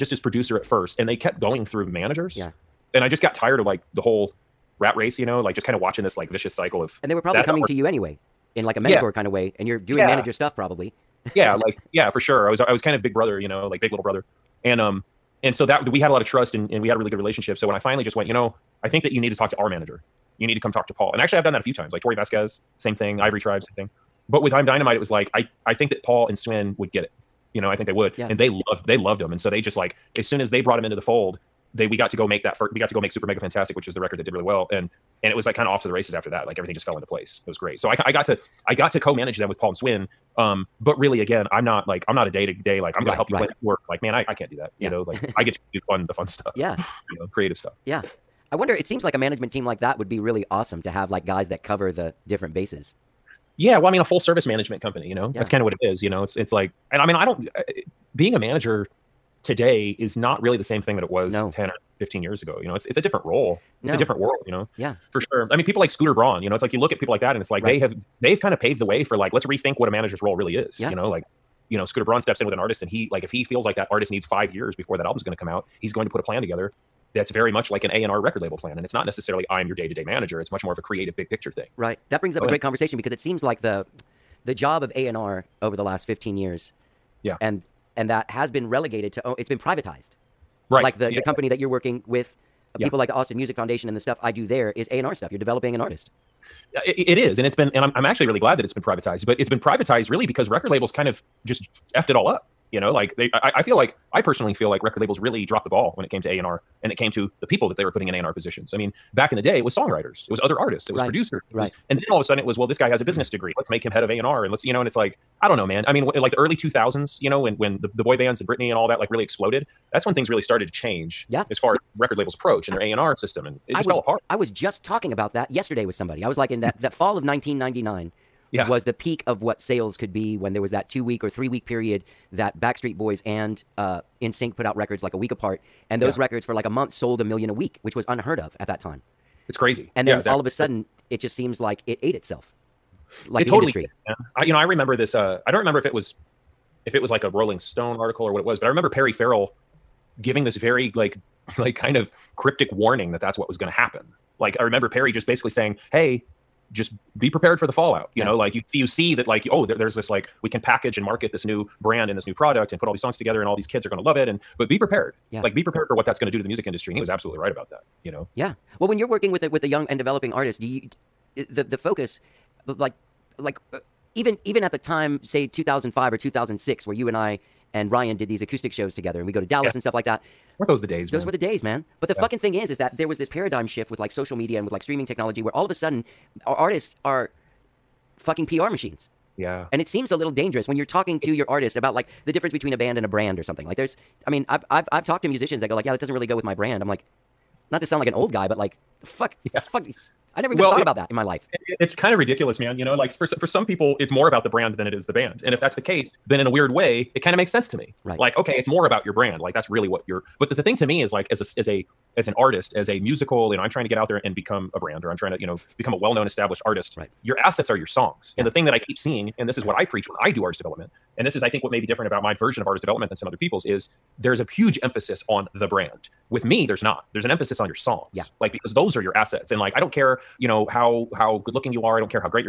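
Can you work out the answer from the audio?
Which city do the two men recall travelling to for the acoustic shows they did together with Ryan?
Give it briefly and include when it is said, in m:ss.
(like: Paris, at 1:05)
Dallas, at 2:59.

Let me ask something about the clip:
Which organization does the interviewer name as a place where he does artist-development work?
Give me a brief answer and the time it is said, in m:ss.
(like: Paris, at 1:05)
Austin Music Foundation, at 1:33.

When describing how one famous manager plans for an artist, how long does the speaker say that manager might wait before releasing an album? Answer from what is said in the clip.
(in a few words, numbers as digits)
5 years.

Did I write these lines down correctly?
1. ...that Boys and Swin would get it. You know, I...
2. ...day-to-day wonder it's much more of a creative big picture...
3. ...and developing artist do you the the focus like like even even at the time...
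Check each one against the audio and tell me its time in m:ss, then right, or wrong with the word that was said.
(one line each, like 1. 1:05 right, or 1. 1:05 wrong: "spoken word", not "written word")
1. 0:25 wrong: "Paul", not "Boys"
2. 1:19 wrong: "manager", not "wonder"
3. 2:49 right.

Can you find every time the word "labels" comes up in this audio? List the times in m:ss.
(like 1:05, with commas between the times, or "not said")
1:18, 1:40, 1:44, 2:02.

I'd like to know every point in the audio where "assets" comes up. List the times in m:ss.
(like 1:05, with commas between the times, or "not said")
3:37, 3:49.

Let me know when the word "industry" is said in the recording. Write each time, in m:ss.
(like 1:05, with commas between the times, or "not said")
2:23, 2:46.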